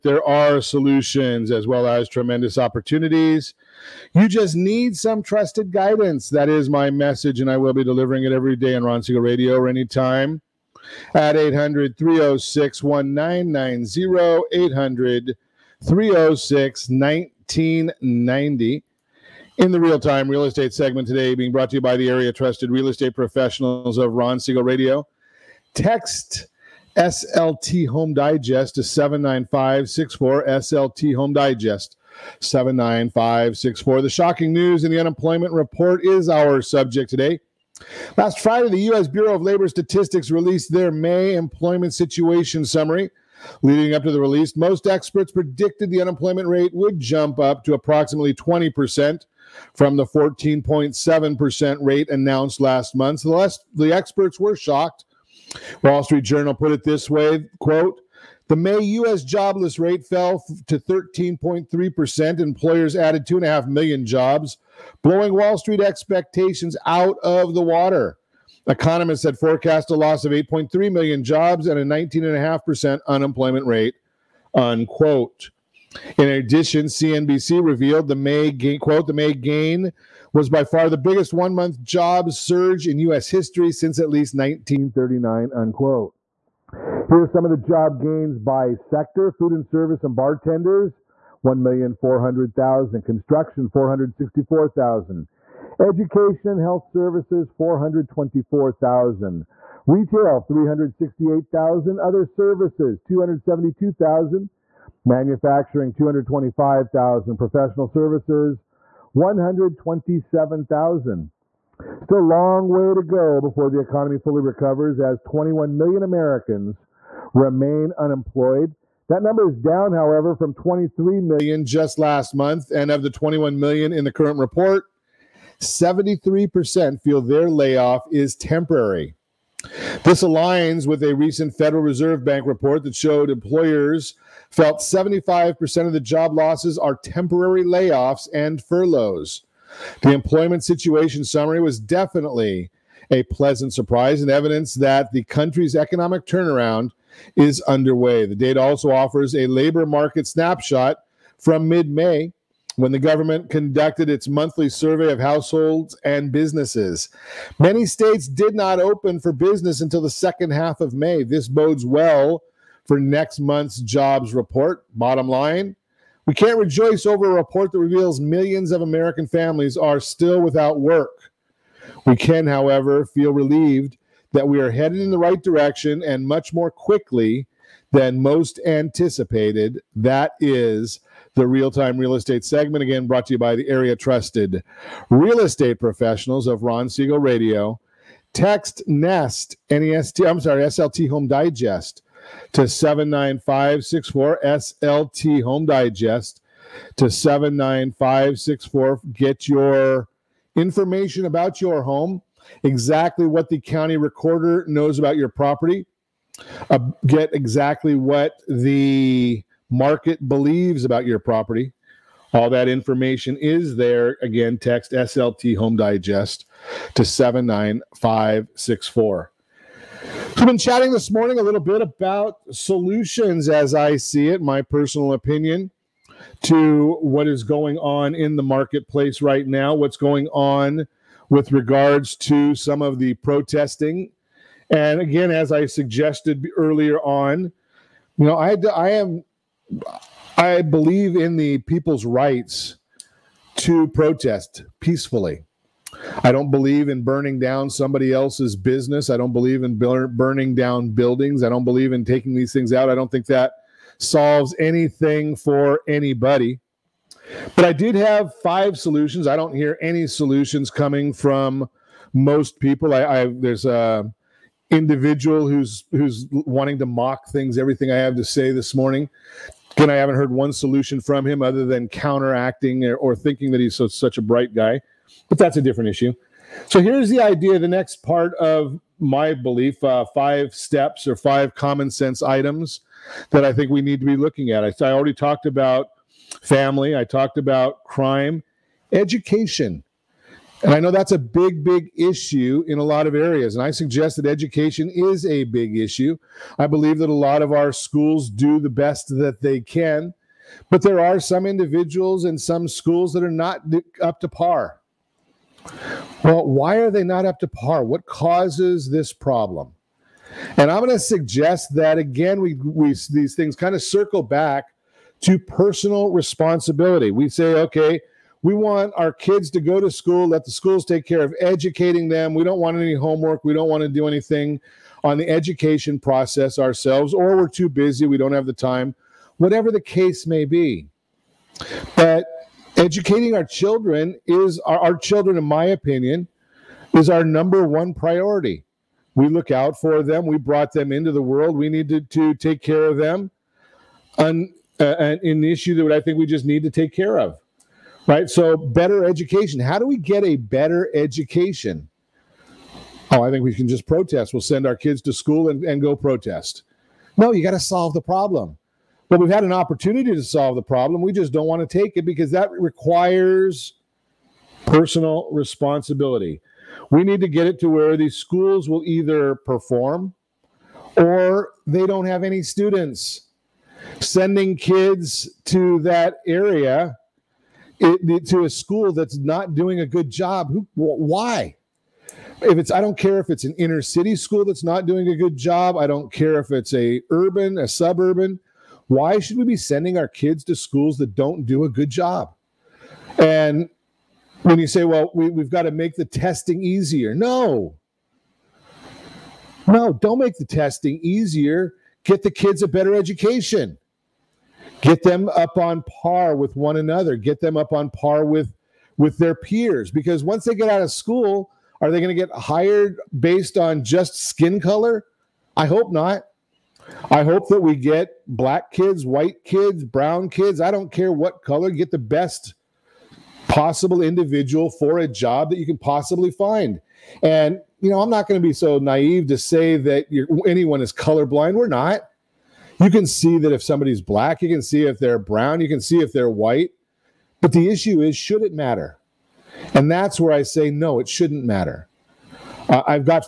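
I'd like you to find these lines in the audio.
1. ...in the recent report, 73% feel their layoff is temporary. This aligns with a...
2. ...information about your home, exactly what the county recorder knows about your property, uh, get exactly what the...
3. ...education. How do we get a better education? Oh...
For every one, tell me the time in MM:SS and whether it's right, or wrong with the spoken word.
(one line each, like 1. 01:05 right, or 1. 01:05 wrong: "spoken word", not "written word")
1. 02:03 wrong: "current", not "recent"
2. 03:20 right
3. 05:49 right.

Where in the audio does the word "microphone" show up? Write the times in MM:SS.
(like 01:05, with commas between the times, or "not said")
not said.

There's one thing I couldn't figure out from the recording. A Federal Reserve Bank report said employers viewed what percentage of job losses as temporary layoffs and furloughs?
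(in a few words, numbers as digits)
75%.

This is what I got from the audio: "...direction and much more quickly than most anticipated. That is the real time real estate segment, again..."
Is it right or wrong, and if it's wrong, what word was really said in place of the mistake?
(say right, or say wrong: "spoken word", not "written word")
right.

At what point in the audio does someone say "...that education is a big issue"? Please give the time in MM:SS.
04:54.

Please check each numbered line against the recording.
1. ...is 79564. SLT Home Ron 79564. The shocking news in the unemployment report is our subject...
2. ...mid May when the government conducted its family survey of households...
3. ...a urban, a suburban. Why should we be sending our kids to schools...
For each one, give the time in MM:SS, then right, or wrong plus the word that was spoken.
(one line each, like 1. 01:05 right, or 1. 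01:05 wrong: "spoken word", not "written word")
1. 00:28 wrong: "Digest", not "Ron"
2. 02:31 wrong: "monthly", not "family"
3. 06:26 right.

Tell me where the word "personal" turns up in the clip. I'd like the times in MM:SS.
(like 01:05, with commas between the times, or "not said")
03:44, 05:15, 06:04.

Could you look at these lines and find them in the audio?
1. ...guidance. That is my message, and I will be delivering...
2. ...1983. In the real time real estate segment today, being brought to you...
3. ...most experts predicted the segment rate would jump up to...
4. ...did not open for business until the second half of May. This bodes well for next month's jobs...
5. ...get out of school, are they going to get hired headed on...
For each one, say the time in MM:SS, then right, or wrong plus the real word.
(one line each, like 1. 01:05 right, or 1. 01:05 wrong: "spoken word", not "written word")
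1. 00:05 right
2. 00:16 wrong: "1990", not "1983"
3. 00:44 wrong: "unemployment", not "segment"
4. 02:38 right
5. 06:50 wrong: "based", not "headed".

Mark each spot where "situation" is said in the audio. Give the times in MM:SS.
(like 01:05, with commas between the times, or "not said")
00:41, 02:20.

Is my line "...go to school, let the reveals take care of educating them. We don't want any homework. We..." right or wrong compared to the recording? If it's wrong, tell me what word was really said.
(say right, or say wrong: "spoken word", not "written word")
wrong: "schools", not "reveals".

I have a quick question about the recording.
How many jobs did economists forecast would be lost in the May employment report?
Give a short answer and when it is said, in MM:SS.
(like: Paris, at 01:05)
8.3 million, at 01:10.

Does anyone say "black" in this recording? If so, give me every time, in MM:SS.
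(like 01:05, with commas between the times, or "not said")
06:58, 07:14.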